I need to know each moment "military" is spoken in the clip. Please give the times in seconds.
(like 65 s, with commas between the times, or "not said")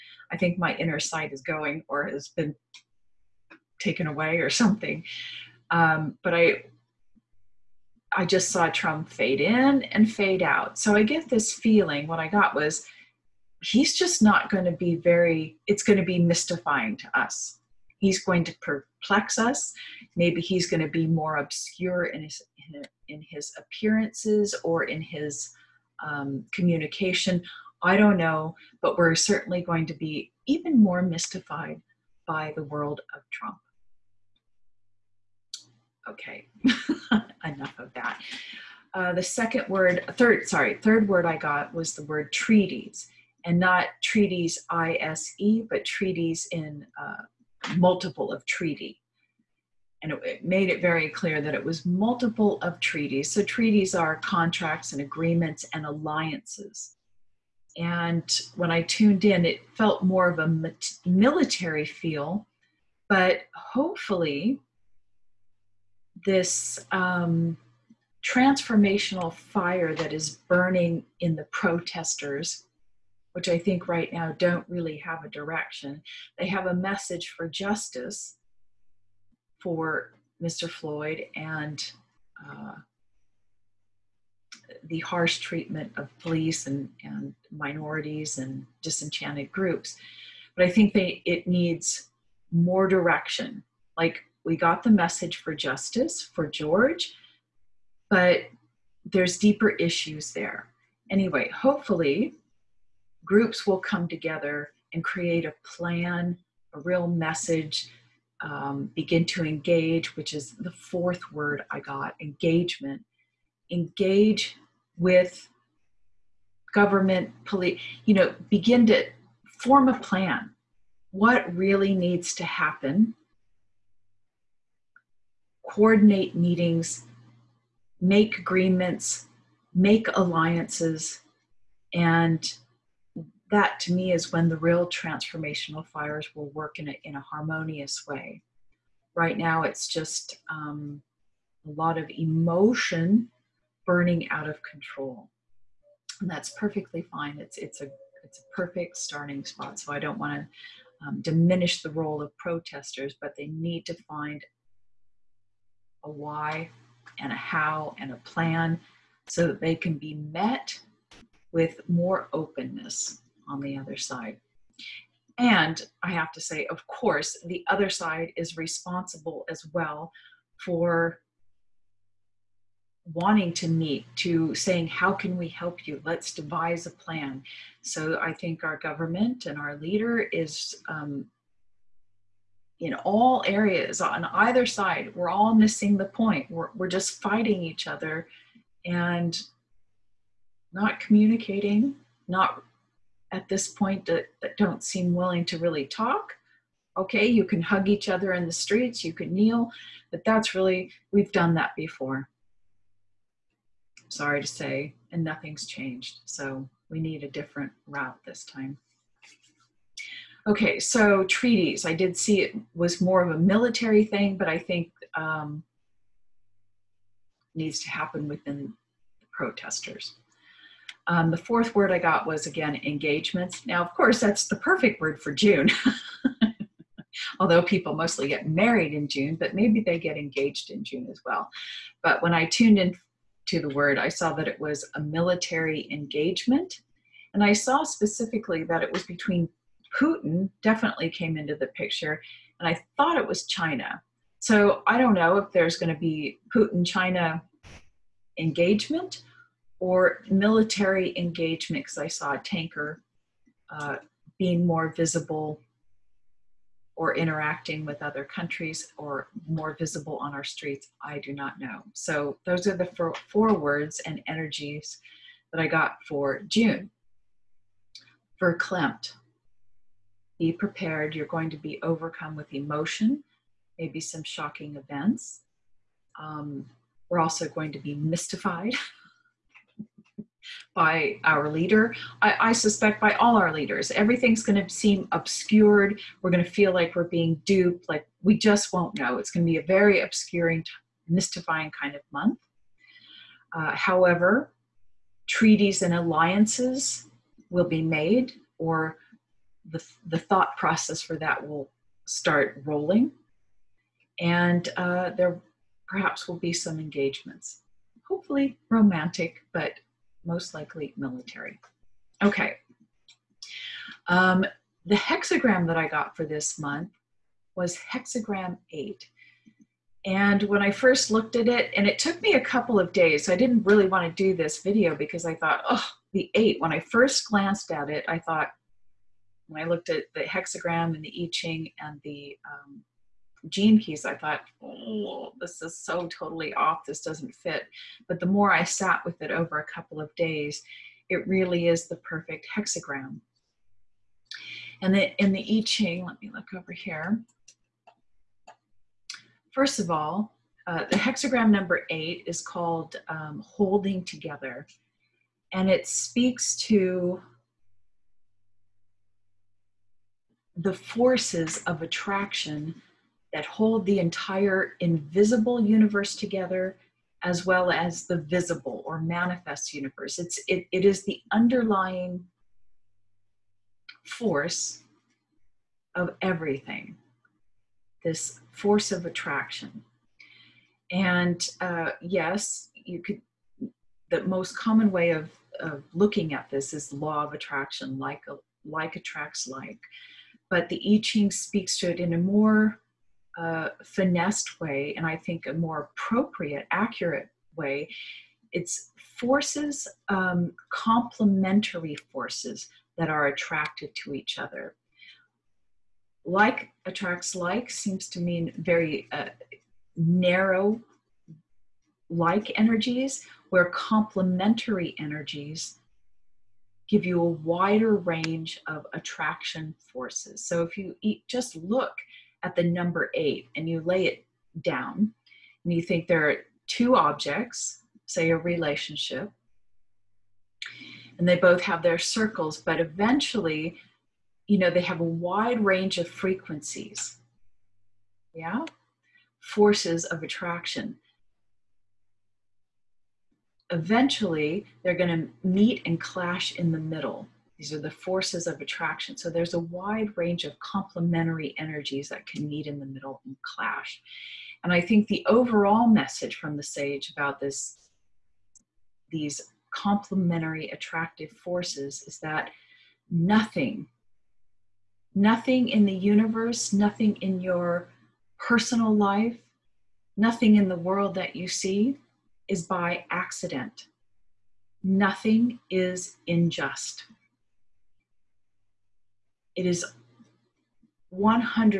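61 s, 213 s, 234 s, 250 s, 310 s.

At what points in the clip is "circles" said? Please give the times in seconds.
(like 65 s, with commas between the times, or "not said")
431 s.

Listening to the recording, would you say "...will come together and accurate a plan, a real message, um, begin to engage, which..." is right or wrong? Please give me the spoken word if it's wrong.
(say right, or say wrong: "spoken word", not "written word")
wrong: "create", not "accurate".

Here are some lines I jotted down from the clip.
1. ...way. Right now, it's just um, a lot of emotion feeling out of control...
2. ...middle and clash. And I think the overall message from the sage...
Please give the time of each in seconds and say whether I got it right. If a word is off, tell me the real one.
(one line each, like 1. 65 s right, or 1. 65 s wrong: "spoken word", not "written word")
1. 138 s wrong: "burning", not "feeling"
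2. 452 s right.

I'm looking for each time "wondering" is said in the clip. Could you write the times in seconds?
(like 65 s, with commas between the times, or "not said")
not said.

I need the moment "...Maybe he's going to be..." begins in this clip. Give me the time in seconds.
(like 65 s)
20 s.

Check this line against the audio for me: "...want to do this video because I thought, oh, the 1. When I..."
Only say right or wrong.
wrong.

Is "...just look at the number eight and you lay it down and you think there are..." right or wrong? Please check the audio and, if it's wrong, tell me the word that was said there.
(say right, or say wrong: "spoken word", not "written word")
right.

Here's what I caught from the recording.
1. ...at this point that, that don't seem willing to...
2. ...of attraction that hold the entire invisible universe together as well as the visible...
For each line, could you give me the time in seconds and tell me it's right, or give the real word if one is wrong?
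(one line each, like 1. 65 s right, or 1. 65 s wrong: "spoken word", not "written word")
1. 193 s right
2. 361 s right.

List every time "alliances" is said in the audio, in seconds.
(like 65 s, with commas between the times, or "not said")
55 s, 130 s, 295 s.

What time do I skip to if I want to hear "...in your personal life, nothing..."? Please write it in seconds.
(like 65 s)
467 s.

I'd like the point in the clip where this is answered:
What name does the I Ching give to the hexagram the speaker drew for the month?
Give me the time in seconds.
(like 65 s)
353 s.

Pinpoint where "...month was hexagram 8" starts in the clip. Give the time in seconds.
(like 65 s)
316 s.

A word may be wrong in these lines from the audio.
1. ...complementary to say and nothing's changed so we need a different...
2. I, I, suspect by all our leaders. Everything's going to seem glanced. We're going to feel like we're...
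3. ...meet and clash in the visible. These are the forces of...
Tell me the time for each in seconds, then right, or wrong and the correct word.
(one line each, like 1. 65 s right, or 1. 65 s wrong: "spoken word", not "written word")
1. 204 s wrong: "sorry", not "complementary"
2. 282 s wrong: "obscured", not "glanced"
3. 445 s wrong: "middle", not "visible".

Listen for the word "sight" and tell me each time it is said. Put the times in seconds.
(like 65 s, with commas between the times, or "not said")
0 s.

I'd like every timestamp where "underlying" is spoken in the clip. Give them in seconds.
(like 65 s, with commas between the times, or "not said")
371 s.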